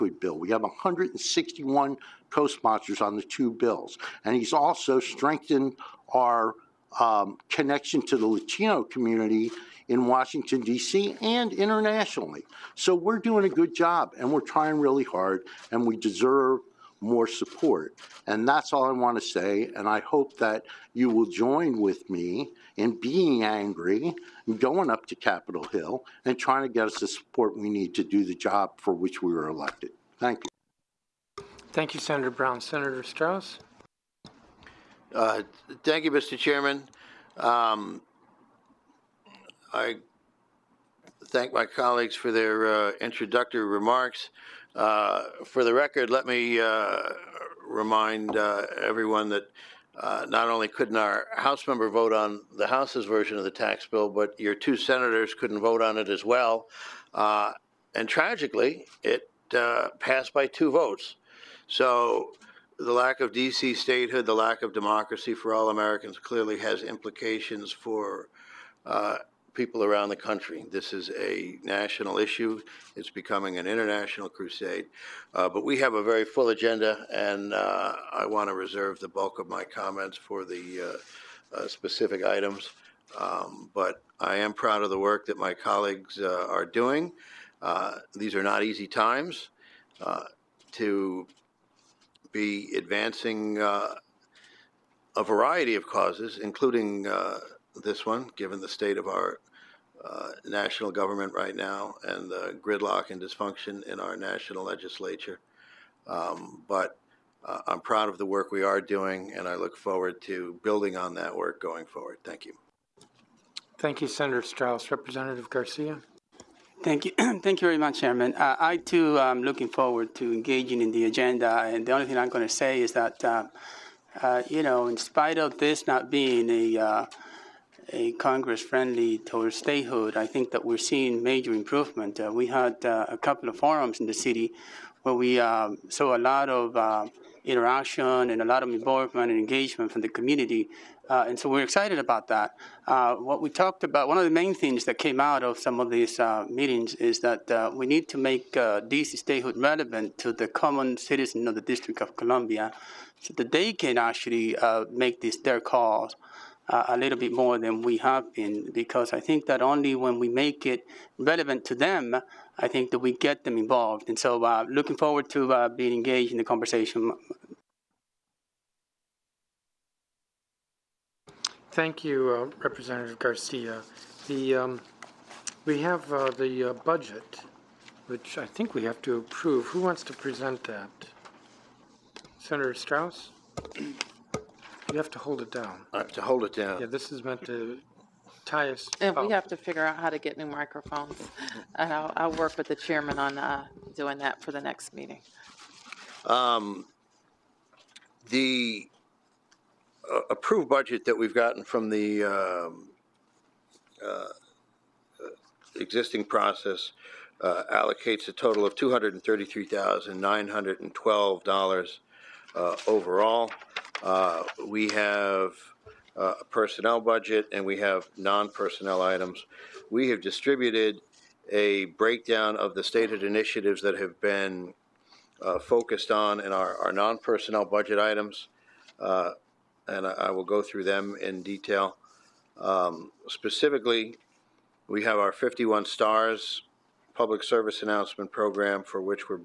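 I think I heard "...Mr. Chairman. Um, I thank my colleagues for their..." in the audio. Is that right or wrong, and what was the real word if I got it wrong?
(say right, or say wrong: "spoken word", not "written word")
right.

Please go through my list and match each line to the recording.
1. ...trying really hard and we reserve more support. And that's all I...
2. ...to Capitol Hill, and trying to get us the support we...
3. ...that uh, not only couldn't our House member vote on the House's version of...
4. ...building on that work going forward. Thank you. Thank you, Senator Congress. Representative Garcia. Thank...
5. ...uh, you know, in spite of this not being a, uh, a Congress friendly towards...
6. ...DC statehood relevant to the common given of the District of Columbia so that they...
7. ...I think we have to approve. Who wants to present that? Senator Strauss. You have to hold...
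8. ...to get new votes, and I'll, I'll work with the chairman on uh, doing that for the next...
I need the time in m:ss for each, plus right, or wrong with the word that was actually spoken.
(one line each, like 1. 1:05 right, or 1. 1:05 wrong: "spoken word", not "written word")
1. 0:14 wrong: "deserve", not "reserve"
2. 0:25 right
3. 0:49 right
4. 1:50 wrong: "Strauss", not "Congress"
5. 2:04 right
6. 2:28 wrong: "citizen", not "given"
7. 2:58 right
8. 3:10 wrong: "microphones", not "votes".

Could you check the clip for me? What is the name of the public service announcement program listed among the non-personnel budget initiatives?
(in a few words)
51 stars.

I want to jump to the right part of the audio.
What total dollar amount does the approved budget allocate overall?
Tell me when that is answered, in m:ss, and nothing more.
3:28.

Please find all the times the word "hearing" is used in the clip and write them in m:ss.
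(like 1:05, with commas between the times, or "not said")
not said.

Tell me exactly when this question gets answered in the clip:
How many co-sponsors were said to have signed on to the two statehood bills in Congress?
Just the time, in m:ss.
0:00.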